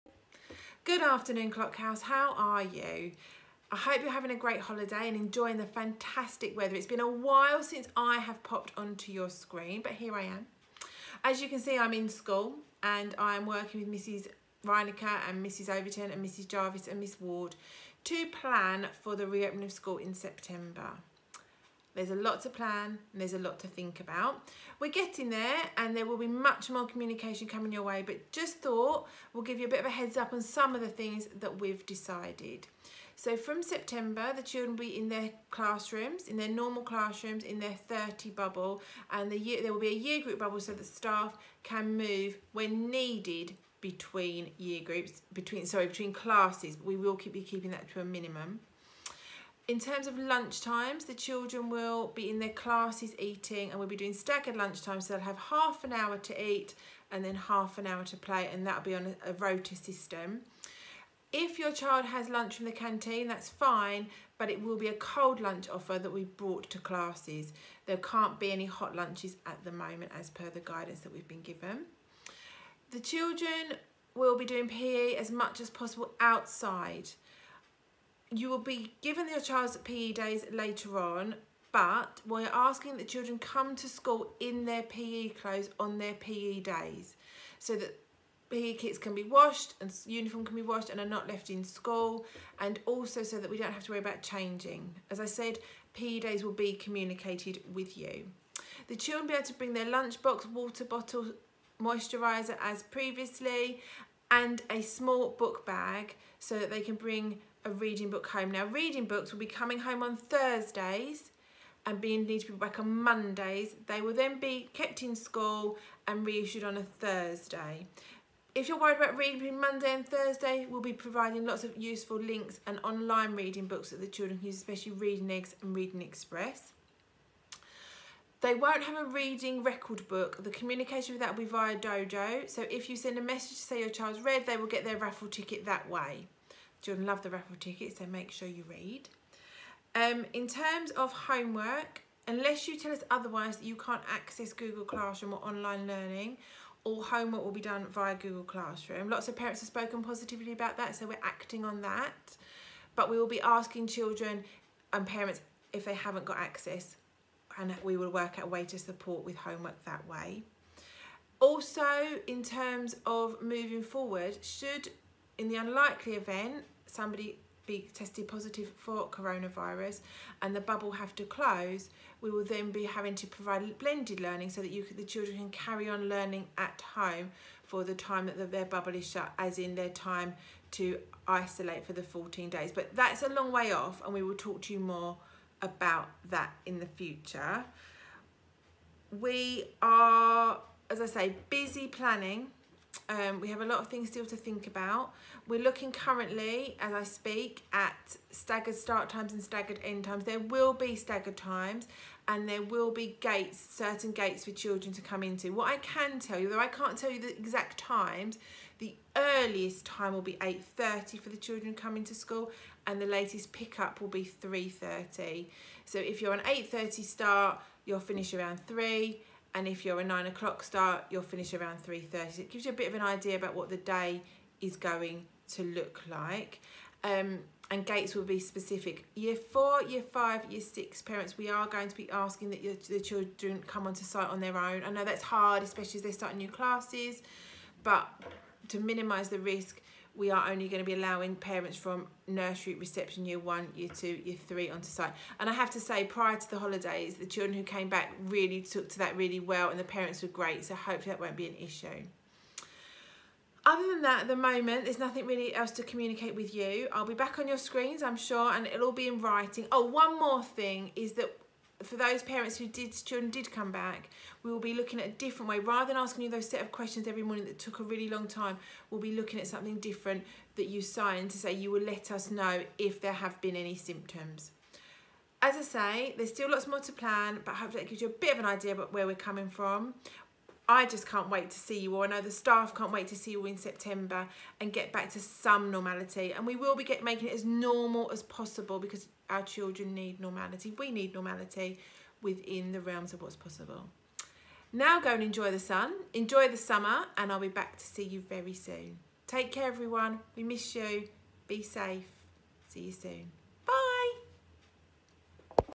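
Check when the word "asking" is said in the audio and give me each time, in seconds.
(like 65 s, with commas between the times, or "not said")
82 s, 153 s, 232 s, 265 s.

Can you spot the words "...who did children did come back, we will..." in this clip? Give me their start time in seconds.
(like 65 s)
262 s.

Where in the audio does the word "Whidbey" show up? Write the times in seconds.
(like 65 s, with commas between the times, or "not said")
not said.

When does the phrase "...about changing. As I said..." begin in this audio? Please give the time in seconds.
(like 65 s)
93 s.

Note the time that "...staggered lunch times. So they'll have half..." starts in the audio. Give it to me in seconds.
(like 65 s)
54 s.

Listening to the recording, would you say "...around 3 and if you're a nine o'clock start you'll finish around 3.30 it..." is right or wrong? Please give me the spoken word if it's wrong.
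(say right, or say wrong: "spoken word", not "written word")
right.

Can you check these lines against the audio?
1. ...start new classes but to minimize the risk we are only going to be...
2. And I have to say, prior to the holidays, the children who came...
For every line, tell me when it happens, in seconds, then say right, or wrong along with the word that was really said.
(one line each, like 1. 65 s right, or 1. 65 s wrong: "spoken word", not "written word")
1. 236 s right
2. 245 s right.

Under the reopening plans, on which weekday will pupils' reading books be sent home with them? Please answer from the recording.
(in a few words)
Thursdays.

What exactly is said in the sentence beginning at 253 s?
Other than that, at the moment, there's nothing really else to communicate with you.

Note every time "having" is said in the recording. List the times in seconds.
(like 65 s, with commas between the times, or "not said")
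4 s, 172 s.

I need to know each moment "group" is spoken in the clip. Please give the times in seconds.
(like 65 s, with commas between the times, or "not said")
40 s, 44 s.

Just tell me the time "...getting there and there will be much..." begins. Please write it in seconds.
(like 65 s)
24 s.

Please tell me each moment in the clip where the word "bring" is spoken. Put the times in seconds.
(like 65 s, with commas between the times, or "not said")
99 s, 106 s.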